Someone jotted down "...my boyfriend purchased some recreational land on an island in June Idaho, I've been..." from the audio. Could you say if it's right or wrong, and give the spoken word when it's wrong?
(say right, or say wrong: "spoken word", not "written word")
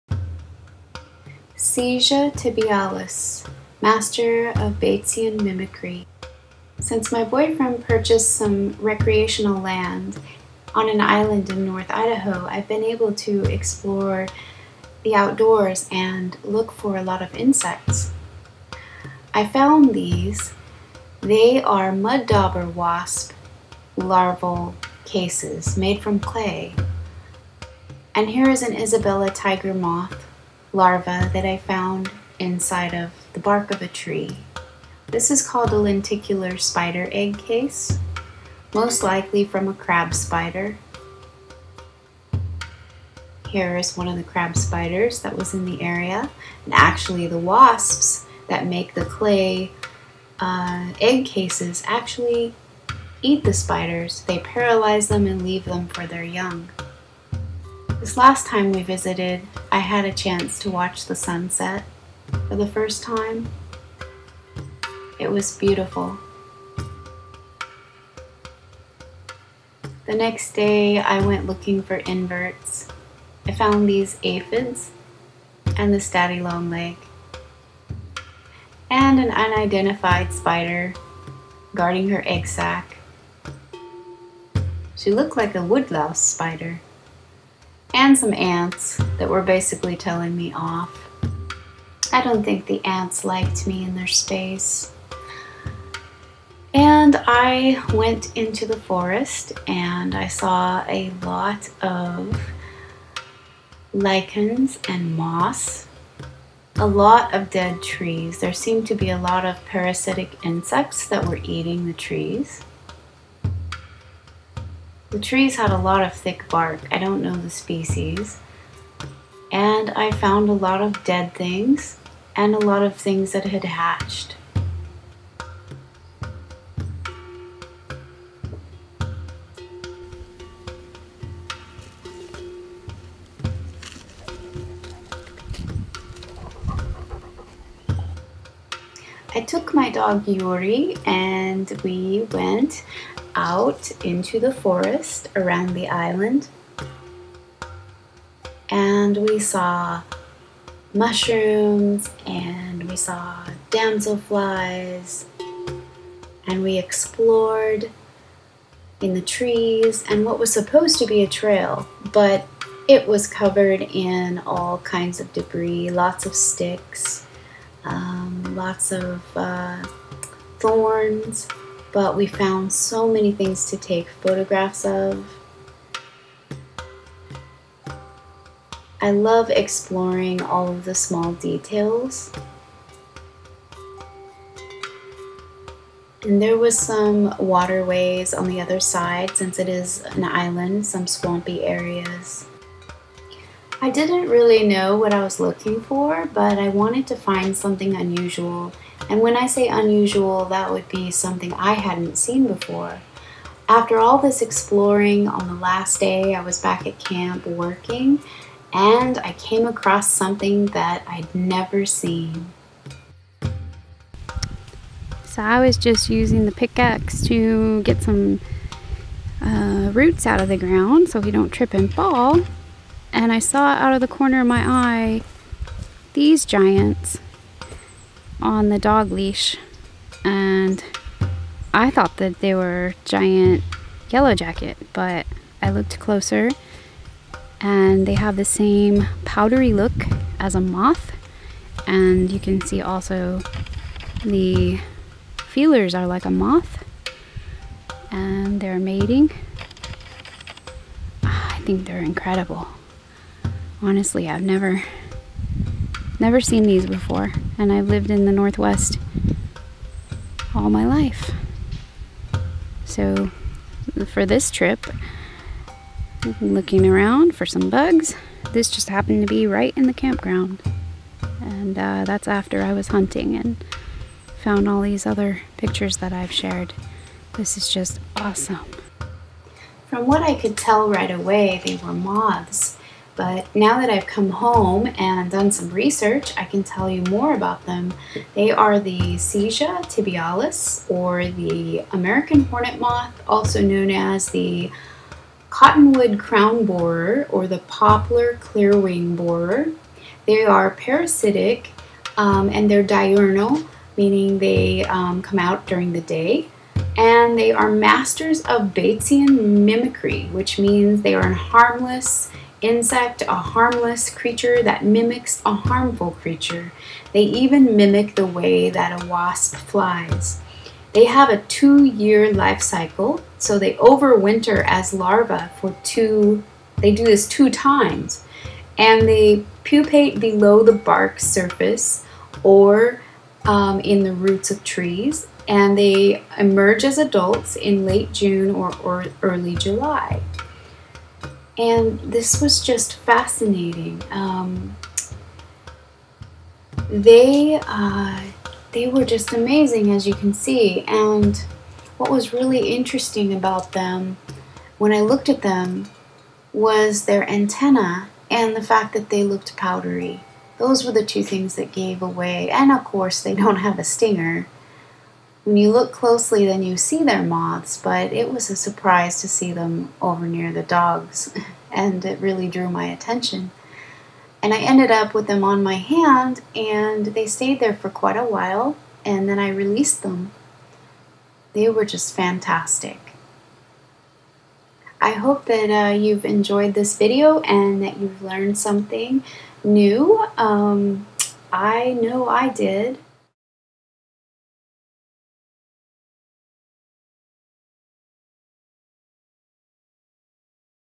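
wrong: "North", not "June".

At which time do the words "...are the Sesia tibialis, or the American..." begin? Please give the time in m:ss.
4:48.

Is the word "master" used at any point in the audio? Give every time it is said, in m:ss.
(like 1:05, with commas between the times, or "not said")
0:03, 5:07.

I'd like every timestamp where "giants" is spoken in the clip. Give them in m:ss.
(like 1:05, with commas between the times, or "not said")
3:46, 3:53.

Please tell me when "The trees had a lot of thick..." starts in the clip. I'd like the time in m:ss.
1:55.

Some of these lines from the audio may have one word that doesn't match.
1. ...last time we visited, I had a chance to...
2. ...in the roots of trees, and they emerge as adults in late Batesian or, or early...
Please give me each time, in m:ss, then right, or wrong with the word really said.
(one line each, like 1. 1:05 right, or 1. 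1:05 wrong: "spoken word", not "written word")
1. 0:58 right
2. 5:33 wrong: "June", not "Batesian".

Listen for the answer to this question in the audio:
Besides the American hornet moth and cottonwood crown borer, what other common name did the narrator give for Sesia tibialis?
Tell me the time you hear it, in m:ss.
4:57.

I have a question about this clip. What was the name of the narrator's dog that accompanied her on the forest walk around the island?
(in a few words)
Yuri.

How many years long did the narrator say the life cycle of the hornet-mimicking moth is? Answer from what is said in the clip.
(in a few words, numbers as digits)
2.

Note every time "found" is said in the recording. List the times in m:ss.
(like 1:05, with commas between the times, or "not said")
0:19, 0:31, 1:13, 2:00, 2:52, 4:34.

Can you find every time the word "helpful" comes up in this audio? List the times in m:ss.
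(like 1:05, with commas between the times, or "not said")
not said.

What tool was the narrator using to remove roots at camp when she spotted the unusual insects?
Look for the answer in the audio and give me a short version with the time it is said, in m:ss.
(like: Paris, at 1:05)
Pickaxe, at 3:36.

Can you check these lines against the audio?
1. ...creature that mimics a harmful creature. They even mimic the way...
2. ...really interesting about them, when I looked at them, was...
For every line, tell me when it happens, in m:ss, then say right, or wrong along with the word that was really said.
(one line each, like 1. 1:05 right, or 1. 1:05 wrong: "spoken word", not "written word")
1. 5:14 right
2. 5:52 right.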